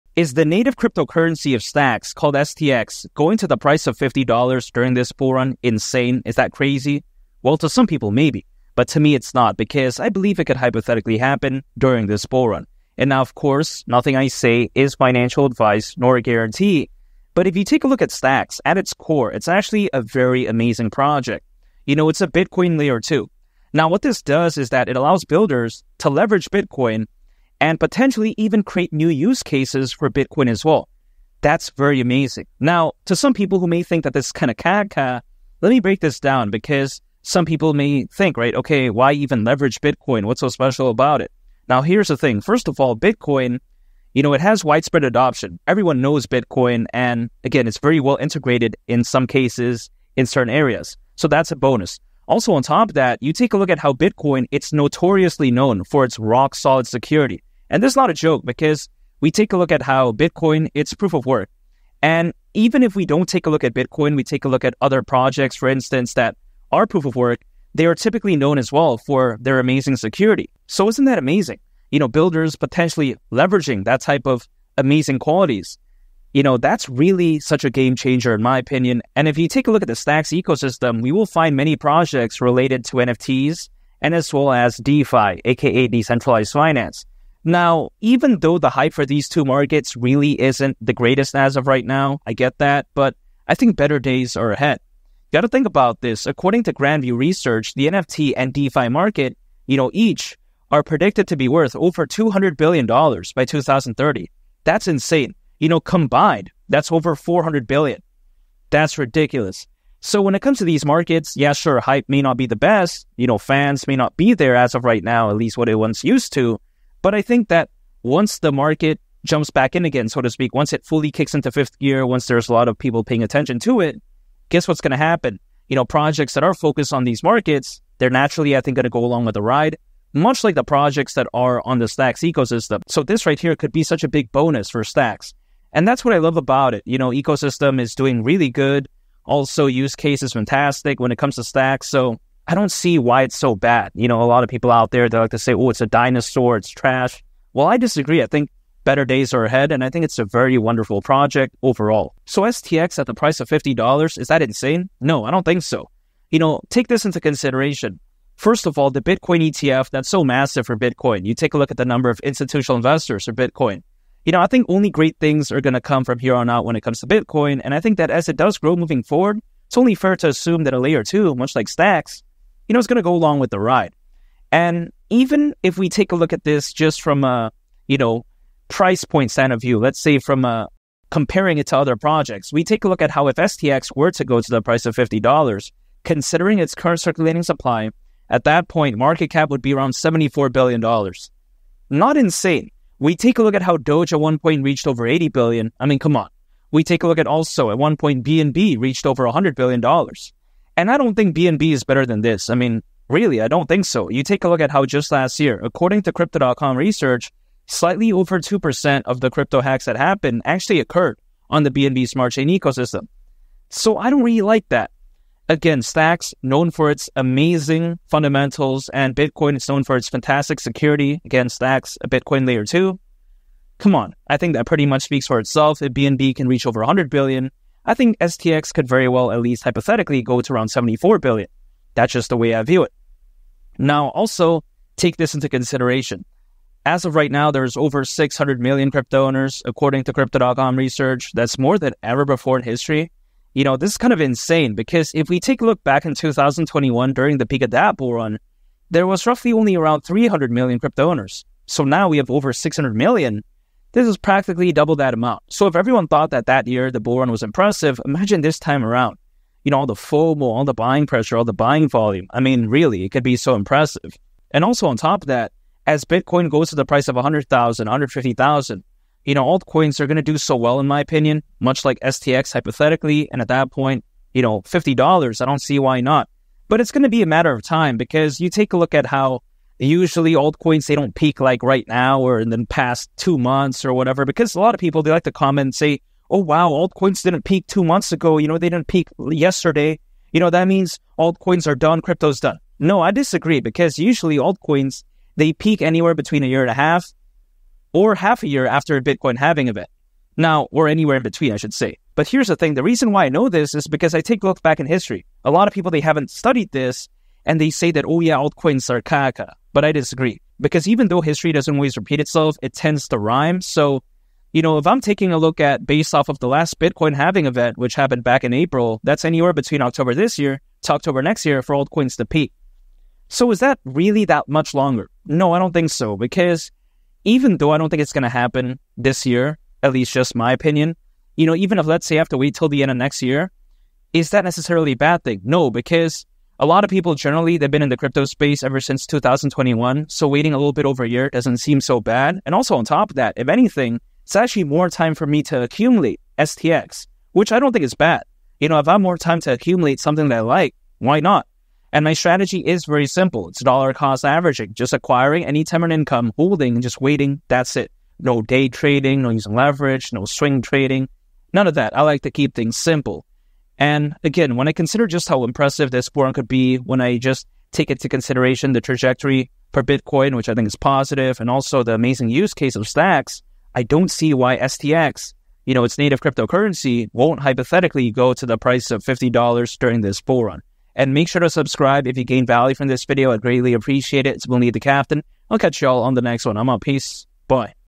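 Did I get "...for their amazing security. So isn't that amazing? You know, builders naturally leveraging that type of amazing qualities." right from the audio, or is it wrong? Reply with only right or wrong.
wrong.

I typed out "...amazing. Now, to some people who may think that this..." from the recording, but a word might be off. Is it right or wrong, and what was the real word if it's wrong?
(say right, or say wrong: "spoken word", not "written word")
right.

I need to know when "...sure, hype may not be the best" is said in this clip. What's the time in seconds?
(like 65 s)
111 s.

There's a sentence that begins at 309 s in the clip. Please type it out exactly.
But I disagree because even though history doesn't always repeat itself, it tends to rhyme.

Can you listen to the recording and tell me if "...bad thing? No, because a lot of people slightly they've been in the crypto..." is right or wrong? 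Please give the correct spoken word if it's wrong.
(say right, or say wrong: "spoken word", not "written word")
wrong: "generally", not "slightly".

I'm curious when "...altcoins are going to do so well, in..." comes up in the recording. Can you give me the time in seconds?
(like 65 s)
269 s.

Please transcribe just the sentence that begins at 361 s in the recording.
I like to keep things simple.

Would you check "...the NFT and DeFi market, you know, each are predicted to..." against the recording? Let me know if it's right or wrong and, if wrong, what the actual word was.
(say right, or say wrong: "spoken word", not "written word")
right.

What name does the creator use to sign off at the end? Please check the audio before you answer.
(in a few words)
Lee the Captain.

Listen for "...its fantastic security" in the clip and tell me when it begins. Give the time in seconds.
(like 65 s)
219 s.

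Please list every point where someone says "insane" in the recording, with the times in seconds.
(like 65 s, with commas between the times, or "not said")
5 s, 104 s, 154 s, 192 s, 244 s.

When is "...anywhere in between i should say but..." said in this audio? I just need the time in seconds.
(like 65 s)
300 s.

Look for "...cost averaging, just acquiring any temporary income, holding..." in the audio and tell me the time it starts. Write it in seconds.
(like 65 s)
353 s.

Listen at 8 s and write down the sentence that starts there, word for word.
But to me, it's not because I believe it could hypothetically happen during this bull run.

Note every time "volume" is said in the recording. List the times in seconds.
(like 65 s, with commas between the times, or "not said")
261 s.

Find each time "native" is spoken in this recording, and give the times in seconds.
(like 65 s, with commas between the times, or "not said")
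0 s, 375 s.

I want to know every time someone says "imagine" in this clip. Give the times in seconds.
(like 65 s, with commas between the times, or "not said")
258 s.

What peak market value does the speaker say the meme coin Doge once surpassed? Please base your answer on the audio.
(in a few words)
80 billion.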